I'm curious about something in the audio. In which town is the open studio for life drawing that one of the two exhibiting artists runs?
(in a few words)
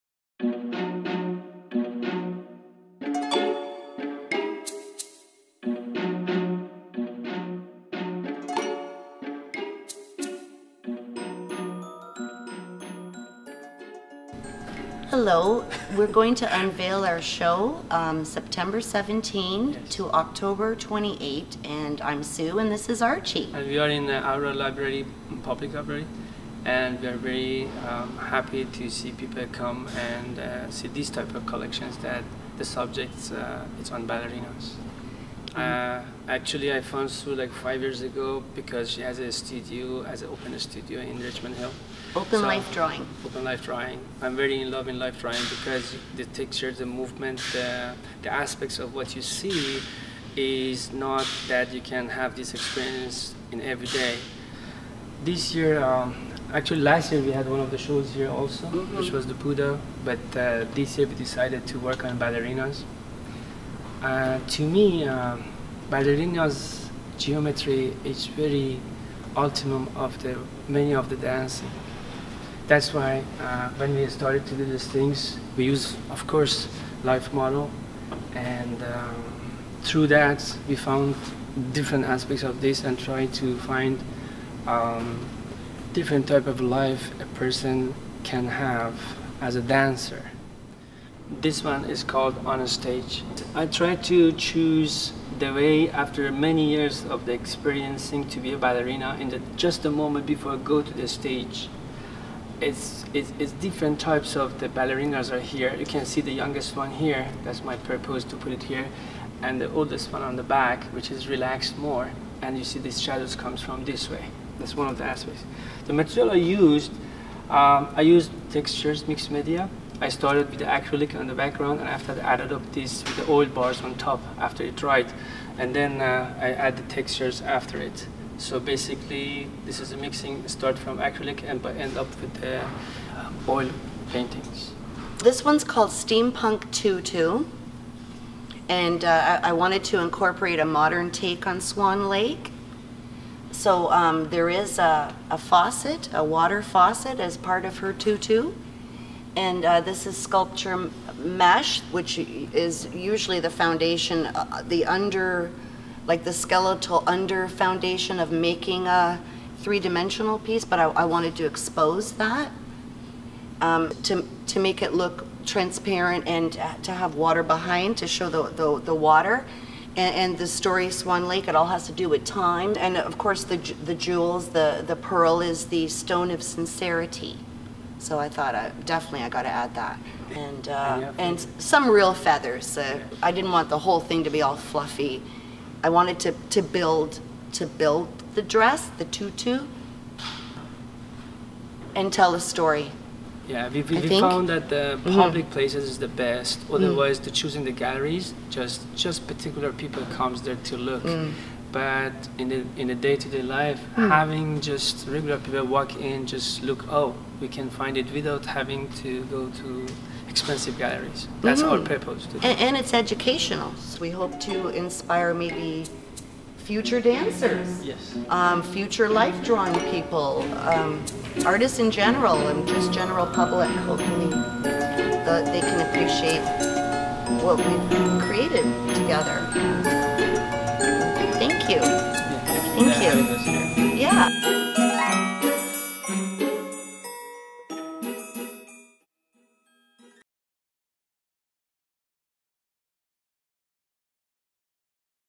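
Richmond Hill.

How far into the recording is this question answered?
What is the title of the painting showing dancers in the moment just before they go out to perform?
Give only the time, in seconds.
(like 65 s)
92 s.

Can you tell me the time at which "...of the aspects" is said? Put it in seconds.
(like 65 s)
114 s.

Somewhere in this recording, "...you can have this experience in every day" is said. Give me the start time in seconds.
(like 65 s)
51 s.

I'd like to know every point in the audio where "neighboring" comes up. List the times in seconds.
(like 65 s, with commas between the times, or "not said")
not said.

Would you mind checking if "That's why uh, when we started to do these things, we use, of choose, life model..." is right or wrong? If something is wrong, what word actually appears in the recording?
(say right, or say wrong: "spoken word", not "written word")
wrong: "course", not "choose".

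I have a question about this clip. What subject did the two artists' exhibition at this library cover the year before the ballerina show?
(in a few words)
The Buddha.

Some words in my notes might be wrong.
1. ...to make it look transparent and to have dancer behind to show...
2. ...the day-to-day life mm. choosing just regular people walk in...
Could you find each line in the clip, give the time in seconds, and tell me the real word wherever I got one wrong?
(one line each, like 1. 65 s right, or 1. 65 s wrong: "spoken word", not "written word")
1. 164 s wrong: "water", not "dancer"
2. 202 s wrong: "having", not "choosing".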